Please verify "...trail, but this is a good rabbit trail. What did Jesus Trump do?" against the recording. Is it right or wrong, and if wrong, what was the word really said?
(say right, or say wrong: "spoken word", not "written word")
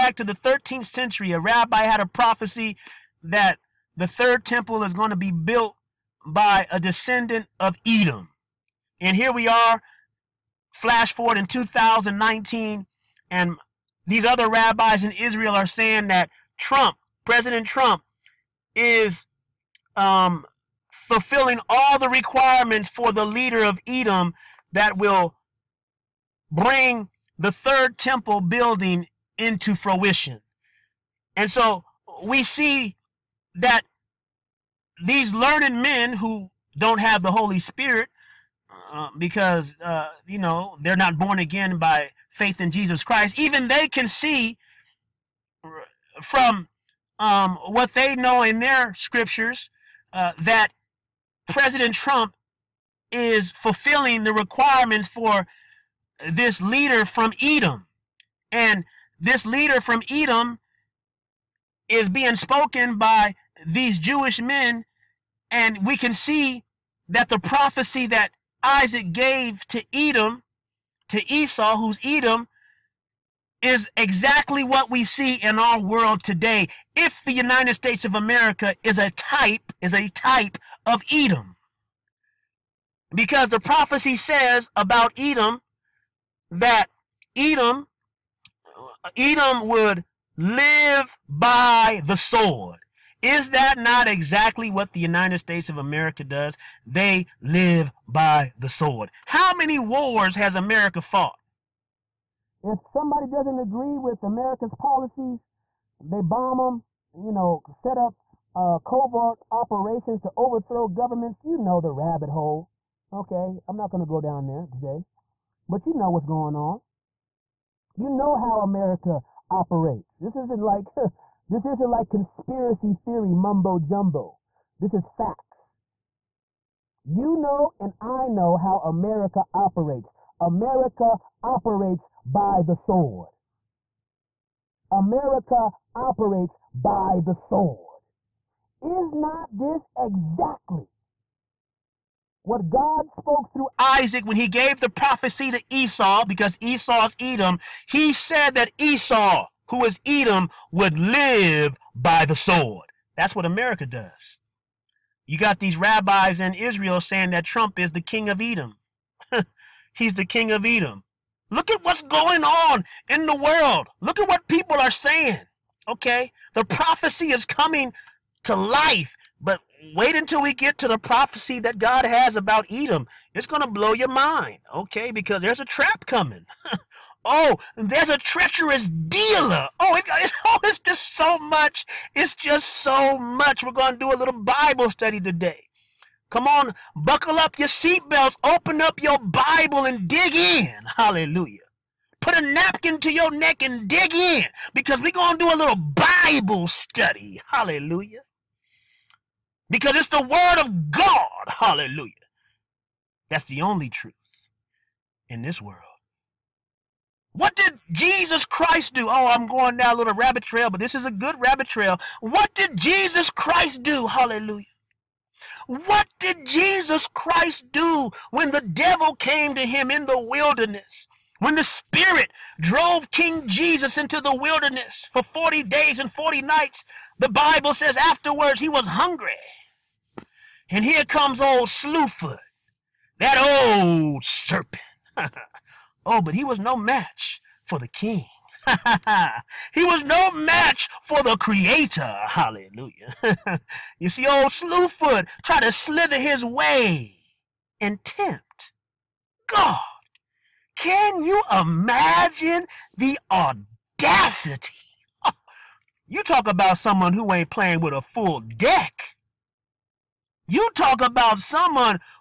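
wrong: "Christ", not "Trump".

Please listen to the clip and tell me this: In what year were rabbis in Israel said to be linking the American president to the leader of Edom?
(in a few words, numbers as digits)
2019.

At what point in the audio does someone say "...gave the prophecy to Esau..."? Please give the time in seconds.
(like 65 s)
144 s.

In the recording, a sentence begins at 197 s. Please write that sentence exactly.
Hallelujah because it's the word of God.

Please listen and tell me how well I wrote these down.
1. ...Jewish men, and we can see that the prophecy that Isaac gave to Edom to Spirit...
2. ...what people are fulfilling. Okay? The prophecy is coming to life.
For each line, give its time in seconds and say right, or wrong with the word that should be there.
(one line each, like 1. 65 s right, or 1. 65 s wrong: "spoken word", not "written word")
1. 63 s wrong: "Esau", not "Spirit"
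2. 164 s wrong: "saying", not "fulfilling".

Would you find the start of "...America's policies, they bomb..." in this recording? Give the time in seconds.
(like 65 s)
104 s.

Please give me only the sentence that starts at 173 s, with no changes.
It's going to blow your mind, okay?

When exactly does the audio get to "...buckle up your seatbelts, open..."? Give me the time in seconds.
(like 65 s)
186 s.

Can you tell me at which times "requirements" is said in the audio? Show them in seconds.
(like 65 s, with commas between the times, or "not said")
22 s, 54 s.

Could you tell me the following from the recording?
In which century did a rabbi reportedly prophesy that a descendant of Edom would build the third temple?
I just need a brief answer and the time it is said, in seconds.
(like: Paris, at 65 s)
13th century, at 0 s.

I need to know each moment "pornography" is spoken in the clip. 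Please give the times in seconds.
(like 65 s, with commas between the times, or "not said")
not said.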